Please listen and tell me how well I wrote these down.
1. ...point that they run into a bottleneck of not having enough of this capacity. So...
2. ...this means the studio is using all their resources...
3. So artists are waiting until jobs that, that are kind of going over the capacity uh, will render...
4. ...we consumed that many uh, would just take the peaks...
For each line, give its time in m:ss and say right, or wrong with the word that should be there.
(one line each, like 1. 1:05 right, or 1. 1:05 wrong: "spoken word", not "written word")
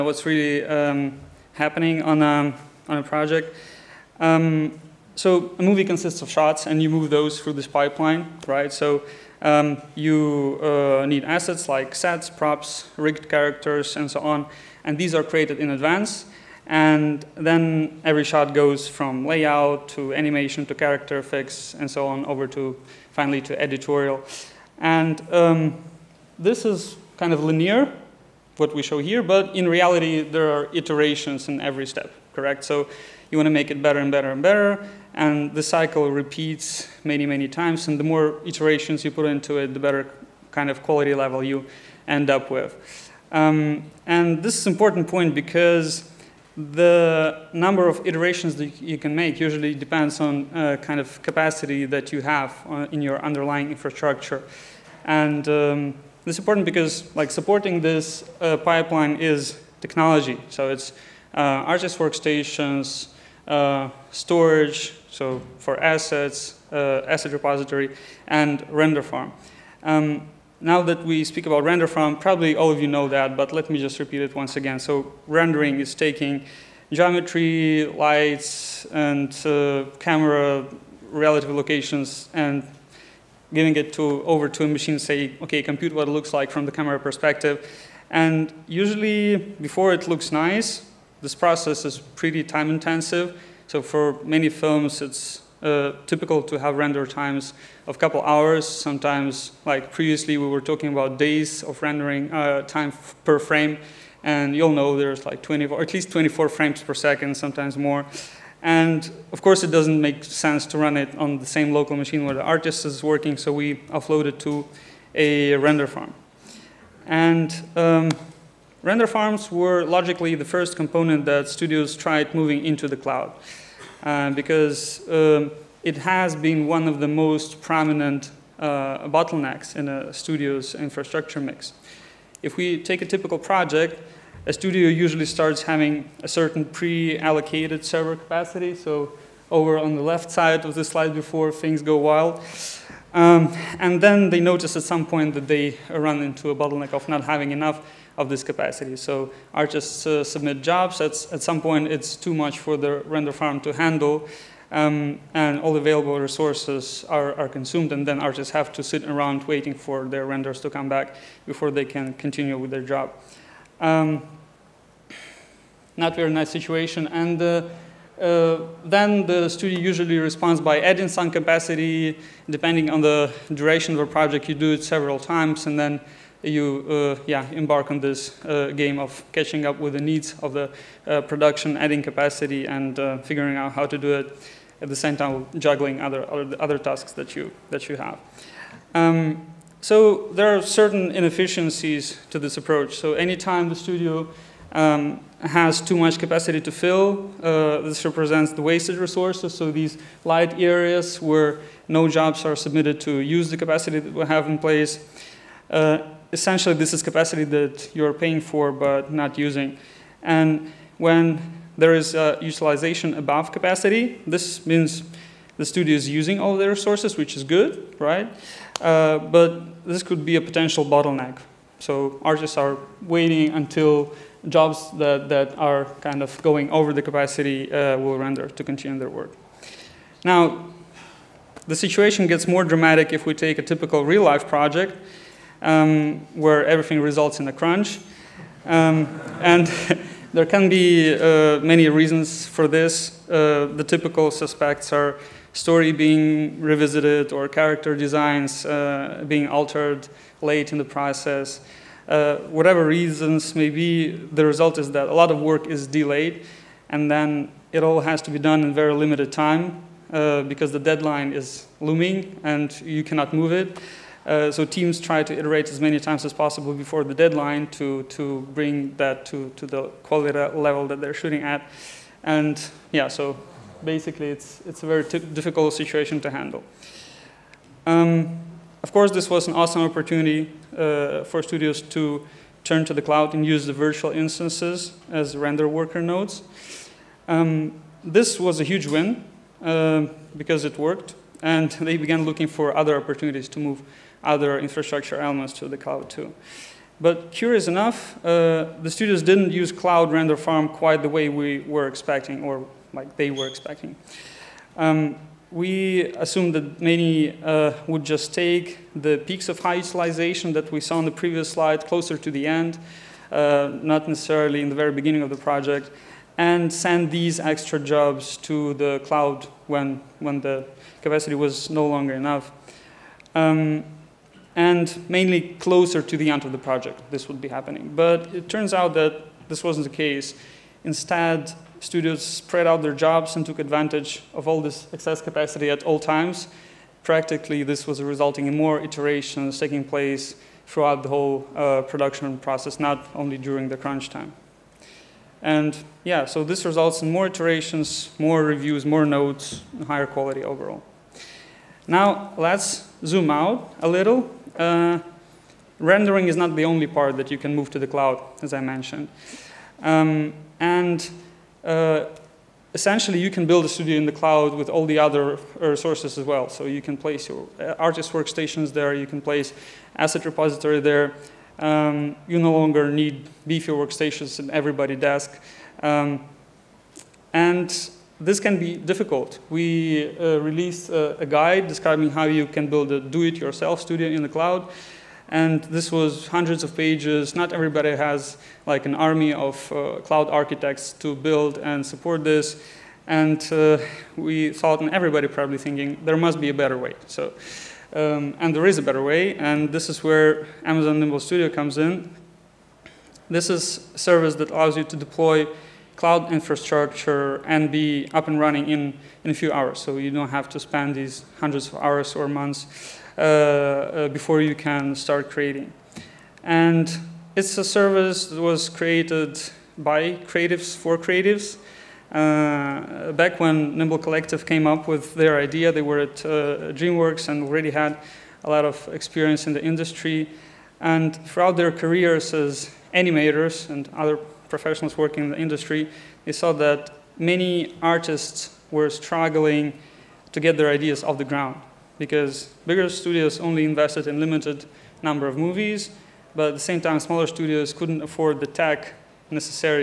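1. 2:25 right
2. 3:34 right
3. 3:41 right
4. 5:05 wrong: "assumed", not "consumed".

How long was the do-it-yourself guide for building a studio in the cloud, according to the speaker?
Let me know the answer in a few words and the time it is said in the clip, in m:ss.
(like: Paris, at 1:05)
Hundreds of pages, at 6:26.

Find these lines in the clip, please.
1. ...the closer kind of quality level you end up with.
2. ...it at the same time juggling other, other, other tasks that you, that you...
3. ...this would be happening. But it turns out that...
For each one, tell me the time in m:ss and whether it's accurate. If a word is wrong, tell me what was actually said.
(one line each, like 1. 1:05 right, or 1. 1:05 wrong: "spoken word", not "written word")
1. 0:39 wrong: "better", not "closer"
2. 3:04 right
3. 5:27 right.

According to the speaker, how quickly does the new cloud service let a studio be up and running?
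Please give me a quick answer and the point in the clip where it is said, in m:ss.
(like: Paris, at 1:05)
A few hours, at 6:49.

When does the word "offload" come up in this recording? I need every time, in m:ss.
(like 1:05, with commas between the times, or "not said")
1:53.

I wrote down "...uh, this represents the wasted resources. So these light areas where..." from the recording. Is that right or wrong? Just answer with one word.
right.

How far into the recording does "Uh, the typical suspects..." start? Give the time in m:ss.
4:03.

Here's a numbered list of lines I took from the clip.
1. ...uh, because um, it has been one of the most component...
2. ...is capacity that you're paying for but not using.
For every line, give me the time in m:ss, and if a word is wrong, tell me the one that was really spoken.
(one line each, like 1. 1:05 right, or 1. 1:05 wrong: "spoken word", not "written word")
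1. 2:04 wrong: "prominent", not "component"
2. 3:26 right.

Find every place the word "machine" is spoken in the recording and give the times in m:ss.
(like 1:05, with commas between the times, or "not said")
1:24, 1:51.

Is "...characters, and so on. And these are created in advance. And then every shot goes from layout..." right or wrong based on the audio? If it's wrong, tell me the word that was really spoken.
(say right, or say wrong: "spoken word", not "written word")
right.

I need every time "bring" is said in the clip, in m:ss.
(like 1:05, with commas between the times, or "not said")
4:28.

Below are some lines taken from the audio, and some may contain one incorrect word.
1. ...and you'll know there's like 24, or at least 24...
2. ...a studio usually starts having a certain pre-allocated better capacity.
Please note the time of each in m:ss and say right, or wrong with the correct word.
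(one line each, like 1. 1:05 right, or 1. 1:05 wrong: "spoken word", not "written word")
1. 1:44 right
2. 2:14 wrong: "server", not "better".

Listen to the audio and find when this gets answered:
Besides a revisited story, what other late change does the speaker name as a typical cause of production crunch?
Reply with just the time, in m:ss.
4:07.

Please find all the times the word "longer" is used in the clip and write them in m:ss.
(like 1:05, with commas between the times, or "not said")
5:21, 6:12.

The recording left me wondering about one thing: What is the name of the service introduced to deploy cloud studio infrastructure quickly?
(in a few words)
Amazon Nimble Studio.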